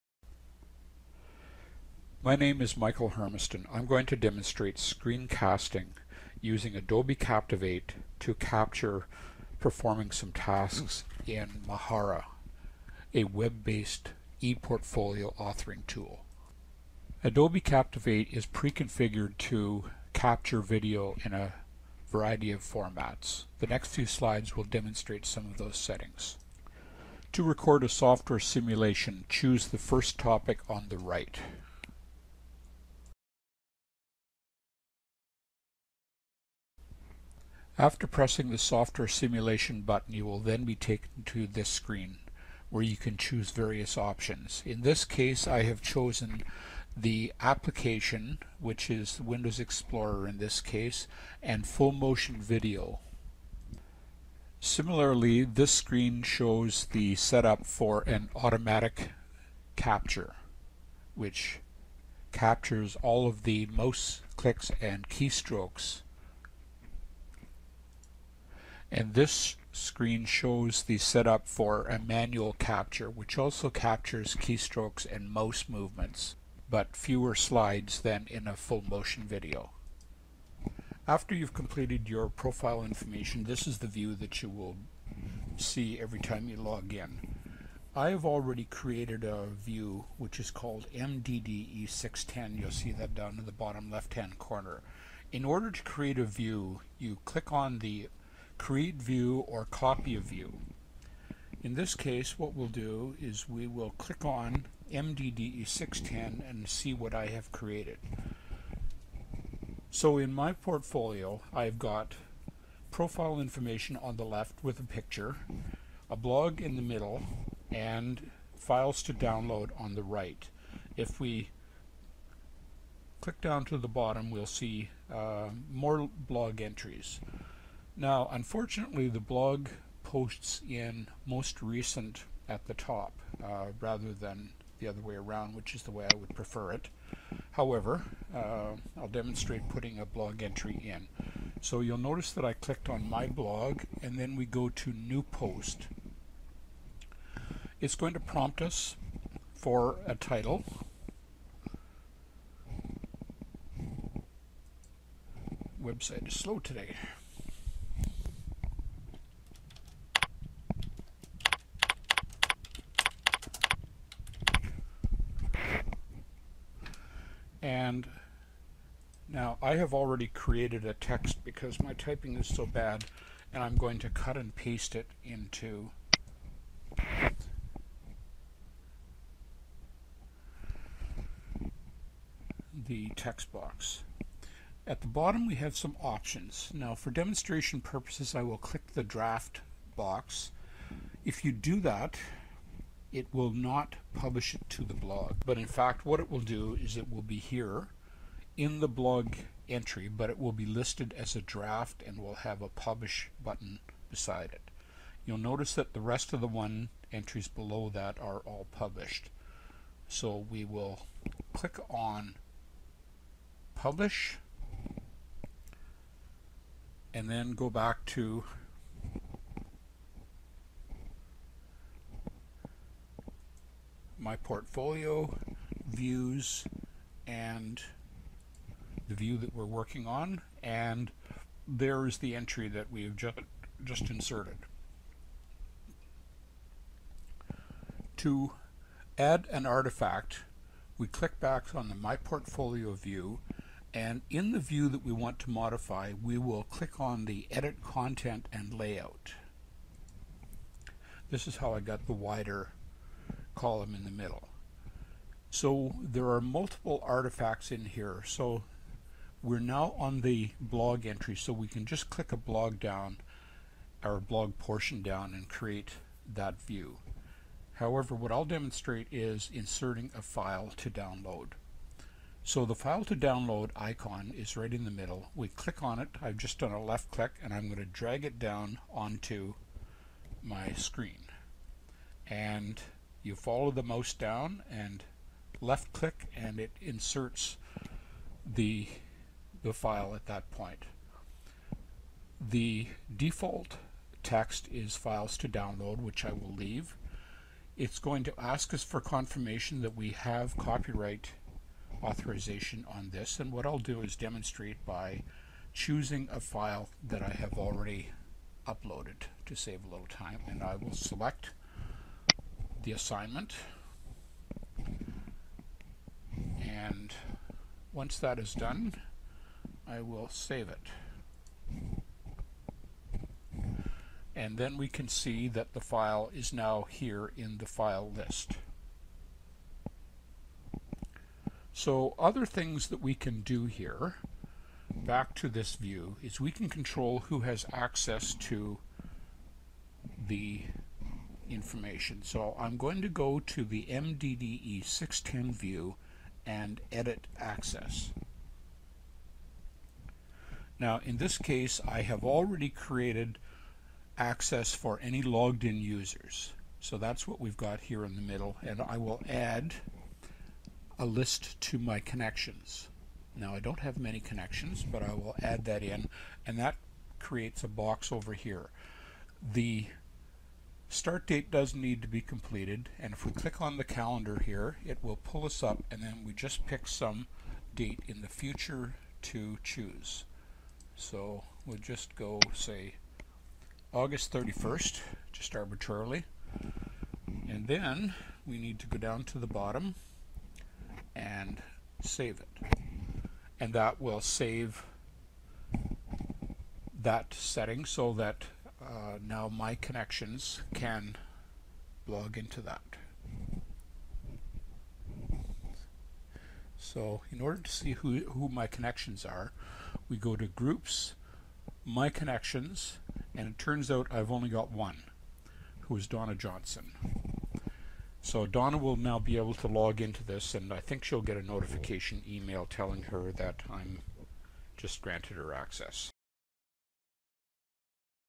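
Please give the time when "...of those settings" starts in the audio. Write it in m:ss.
0:25.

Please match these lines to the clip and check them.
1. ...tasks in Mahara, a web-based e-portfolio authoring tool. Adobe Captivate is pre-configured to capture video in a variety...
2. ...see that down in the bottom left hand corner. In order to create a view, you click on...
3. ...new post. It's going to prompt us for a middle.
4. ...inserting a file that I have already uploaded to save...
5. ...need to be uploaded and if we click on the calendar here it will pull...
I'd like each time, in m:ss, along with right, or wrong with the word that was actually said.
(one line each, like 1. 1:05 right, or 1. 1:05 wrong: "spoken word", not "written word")
1. 0:10 right
2. 1:32 right
3. 2:24 wrong: "title", not "middle"
4. 5:05 wrong: "choosing", not "inserting"
5. 6:11 wrong: "completed", not "uploaded".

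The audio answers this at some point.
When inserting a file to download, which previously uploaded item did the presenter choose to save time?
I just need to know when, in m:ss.
5:12.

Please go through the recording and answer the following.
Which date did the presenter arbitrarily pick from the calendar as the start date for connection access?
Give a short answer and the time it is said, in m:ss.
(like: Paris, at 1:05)
August 31, at 6:23.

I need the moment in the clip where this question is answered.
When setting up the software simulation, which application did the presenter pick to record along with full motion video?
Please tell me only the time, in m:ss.
0:49.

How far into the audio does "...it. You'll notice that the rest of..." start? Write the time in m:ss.
3:24.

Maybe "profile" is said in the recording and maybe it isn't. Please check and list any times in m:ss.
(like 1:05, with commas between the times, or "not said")
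1:22, 1:52.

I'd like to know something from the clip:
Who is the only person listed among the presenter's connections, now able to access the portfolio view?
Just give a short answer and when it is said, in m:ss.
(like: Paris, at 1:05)
Donna Johnson, at 6:56.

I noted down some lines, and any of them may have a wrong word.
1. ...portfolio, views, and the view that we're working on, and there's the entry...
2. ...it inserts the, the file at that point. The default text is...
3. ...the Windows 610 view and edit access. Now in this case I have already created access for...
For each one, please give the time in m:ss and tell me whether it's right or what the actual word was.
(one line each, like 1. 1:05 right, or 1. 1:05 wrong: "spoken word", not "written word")
1. 3:44 right
2. 4:46 right
3. 5:43 wrong: "MDDE", not "Windows".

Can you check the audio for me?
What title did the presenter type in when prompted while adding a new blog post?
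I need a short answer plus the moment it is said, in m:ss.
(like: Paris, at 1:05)
Website is slow today, at 2:35.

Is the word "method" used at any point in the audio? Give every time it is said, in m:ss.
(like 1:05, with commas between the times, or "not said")
not said.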